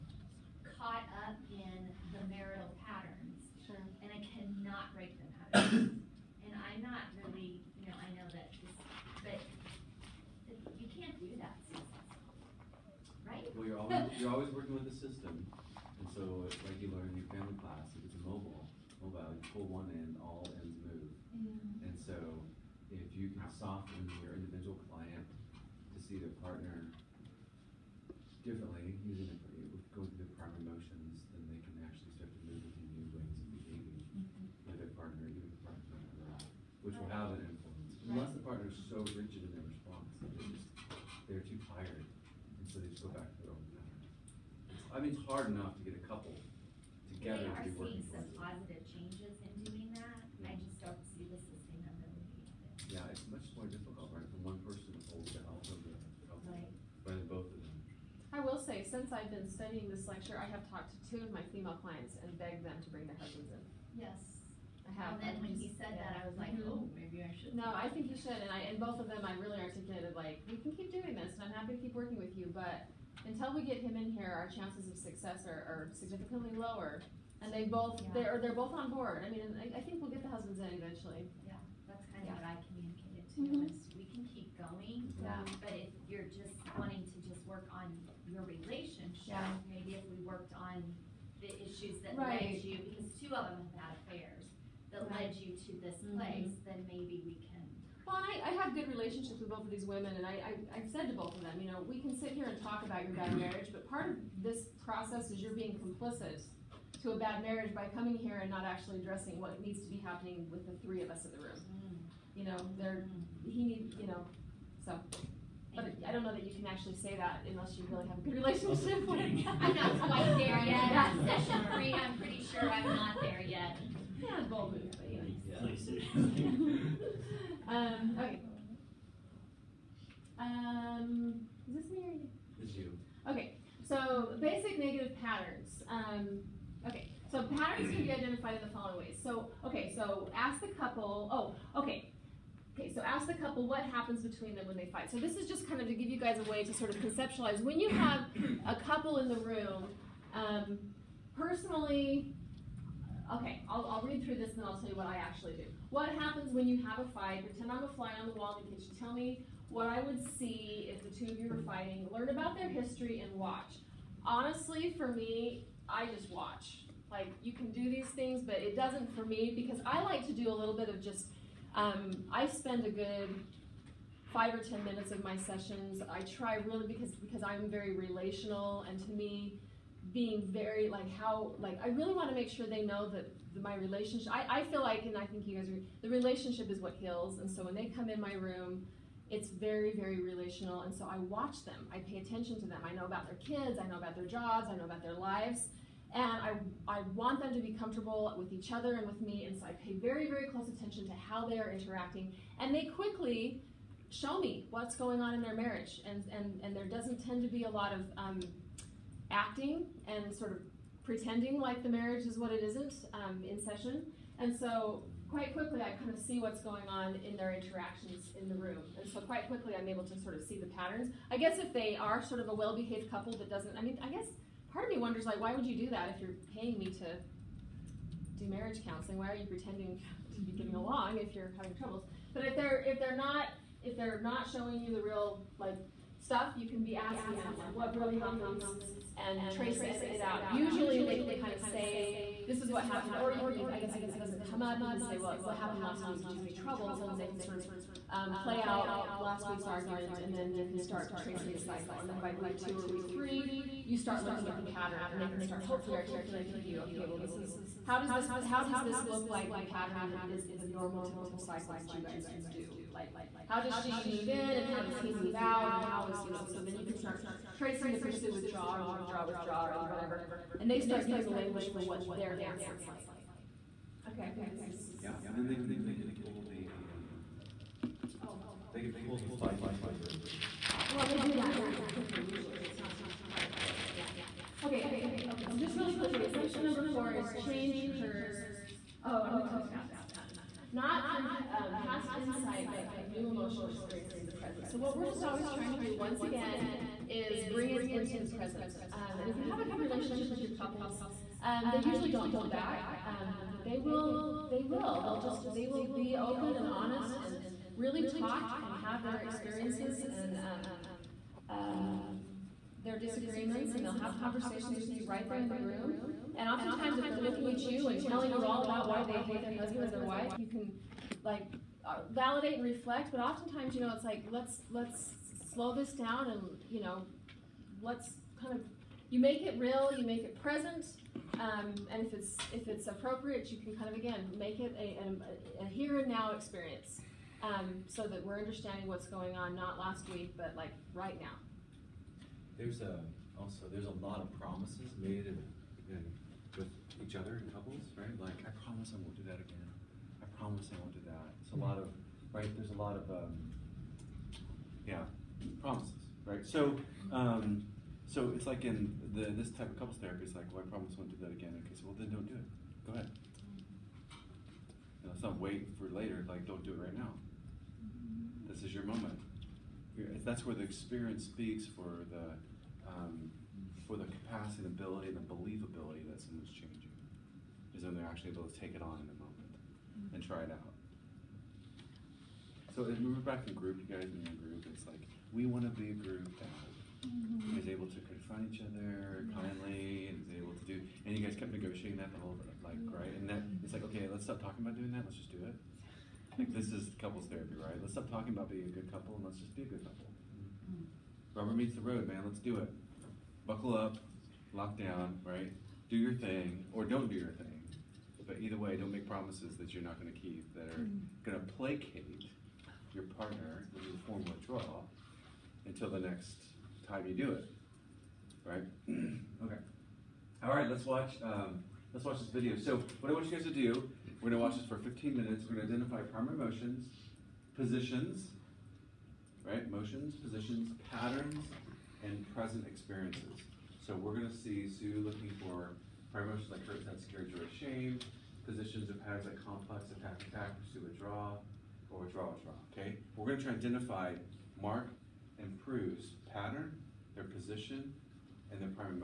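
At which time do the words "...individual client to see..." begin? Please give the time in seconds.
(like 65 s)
24 s.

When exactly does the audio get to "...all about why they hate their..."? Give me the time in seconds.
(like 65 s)
318 s.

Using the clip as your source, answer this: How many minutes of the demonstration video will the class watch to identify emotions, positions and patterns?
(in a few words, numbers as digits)
15.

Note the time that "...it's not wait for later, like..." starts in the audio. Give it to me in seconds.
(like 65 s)
365 s.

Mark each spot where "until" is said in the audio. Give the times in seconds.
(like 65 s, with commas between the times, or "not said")
73 s, 415 s.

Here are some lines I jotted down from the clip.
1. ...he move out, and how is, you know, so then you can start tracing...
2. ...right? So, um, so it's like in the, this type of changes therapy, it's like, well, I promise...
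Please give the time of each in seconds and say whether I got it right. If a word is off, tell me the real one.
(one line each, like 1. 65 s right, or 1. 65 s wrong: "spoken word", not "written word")
1. 264 s right
2. 356 s wrong: "couples", not "changes".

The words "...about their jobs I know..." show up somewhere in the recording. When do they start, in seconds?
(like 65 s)
193 s.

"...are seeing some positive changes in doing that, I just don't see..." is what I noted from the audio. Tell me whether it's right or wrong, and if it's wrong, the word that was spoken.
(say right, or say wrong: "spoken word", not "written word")
right.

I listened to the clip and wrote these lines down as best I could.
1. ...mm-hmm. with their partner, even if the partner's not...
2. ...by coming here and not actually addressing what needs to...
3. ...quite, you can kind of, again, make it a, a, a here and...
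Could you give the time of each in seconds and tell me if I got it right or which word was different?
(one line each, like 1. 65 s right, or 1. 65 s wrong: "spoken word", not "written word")
1. 34 s right
2. 107 s right
3. 332 s wrong: "appropriate", not "quite".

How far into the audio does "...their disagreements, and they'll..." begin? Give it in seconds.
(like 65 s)
312 s.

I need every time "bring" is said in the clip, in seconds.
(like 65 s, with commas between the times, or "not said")
62 s, 297 s.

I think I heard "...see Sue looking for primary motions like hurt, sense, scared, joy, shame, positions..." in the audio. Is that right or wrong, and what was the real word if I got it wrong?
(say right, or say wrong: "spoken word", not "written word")
right.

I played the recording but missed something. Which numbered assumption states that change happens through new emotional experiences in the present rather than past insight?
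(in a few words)
4.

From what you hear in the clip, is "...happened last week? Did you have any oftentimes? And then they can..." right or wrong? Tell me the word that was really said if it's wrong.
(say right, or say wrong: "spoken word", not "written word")
wrong: "troubles", not "oftentimes".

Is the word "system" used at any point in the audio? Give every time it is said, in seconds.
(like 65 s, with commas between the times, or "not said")
14 s.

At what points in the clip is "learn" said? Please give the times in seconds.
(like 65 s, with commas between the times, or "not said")
16 s, 162 s.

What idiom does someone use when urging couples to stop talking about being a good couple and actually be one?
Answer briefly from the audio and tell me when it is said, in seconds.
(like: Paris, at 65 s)
Rubber meets the road, at 401 s.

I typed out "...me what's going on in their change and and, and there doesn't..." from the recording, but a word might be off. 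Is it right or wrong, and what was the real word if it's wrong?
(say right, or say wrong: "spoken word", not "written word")
wrong: "marriage", not "change".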